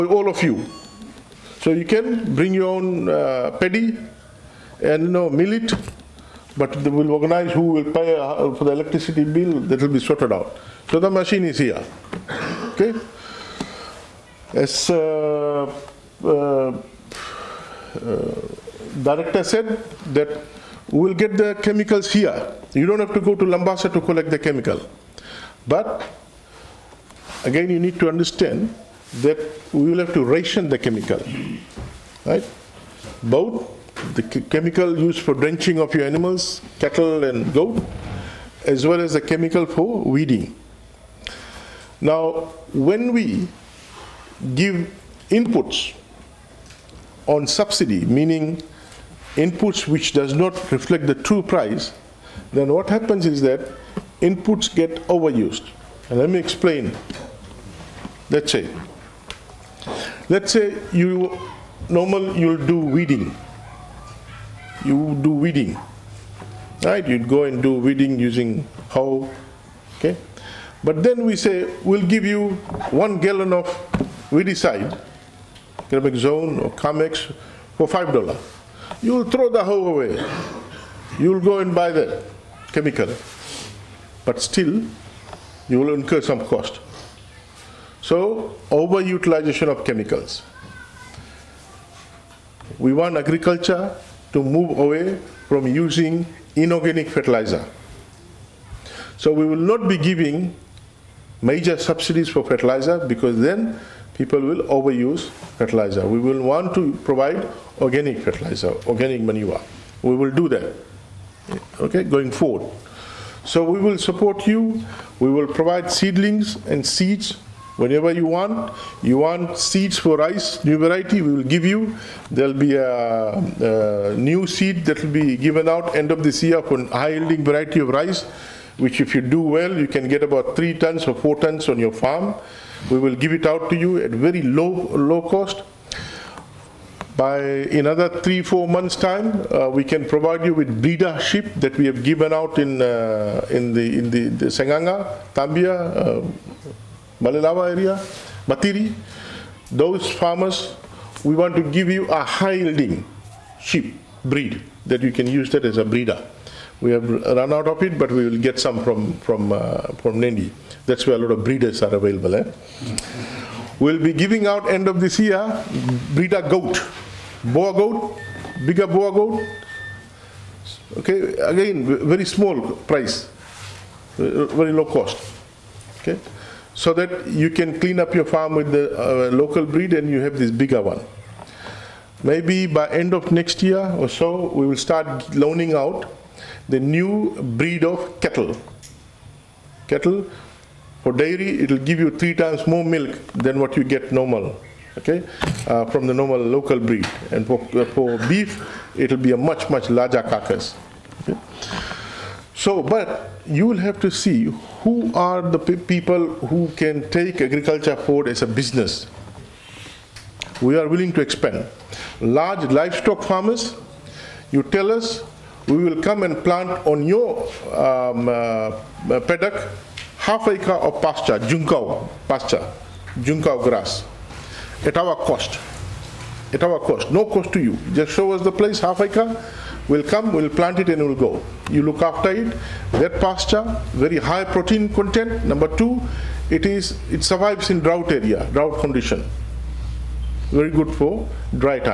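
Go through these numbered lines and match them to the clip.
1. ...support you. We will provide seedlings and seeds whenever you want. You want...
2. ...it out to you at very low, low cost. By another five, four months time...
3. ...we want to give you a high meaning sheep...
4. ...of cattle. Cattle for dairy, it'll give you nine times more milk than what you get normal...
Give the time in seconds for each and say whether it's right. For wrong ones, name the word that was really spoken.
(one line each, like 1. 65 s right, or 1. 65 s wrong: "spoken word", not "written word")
1. 113 s right
2. 133 s wrong: "three", not "five"
3. 151 s wrong: "yielding", not "meaning"
4. 187 s wrong: "three", not "nine".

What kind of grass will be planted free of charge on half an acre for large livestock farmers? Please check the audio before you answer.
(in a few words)
Juncao grass.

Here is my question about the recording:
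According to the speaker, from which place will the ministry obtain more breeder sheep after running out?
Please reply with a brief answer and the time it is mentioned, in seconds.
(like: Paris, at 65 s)
Nadi, at 160 s.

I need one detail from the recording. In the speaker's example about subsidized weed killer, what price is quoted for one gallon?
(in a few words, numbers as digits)
$5.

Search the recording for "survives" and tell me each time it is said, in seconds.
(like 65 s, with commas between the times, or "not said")
237 s.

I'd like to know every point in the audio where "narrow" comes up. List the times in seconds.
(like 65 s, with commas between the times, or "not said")
not said.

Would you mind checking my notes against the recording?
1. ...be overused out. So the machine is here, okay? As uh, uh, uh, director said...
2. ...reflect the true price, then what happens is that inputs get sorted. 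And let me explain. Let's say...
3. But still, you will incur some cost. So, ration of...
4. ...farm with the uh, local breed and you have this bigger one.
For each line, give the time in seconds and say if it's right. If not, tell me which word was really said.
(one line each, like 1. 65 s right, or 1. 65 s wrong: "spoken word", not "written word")
1. 9 s wrong: "sorted", not "overused"
2. 50 s wrong: "overused", not "sorted"
3. 84 s wrong: "overutilization", not "ration"
4. 178 s right.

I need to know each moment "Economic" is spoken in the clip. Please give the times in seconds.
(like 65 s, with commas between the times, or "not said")
75 s.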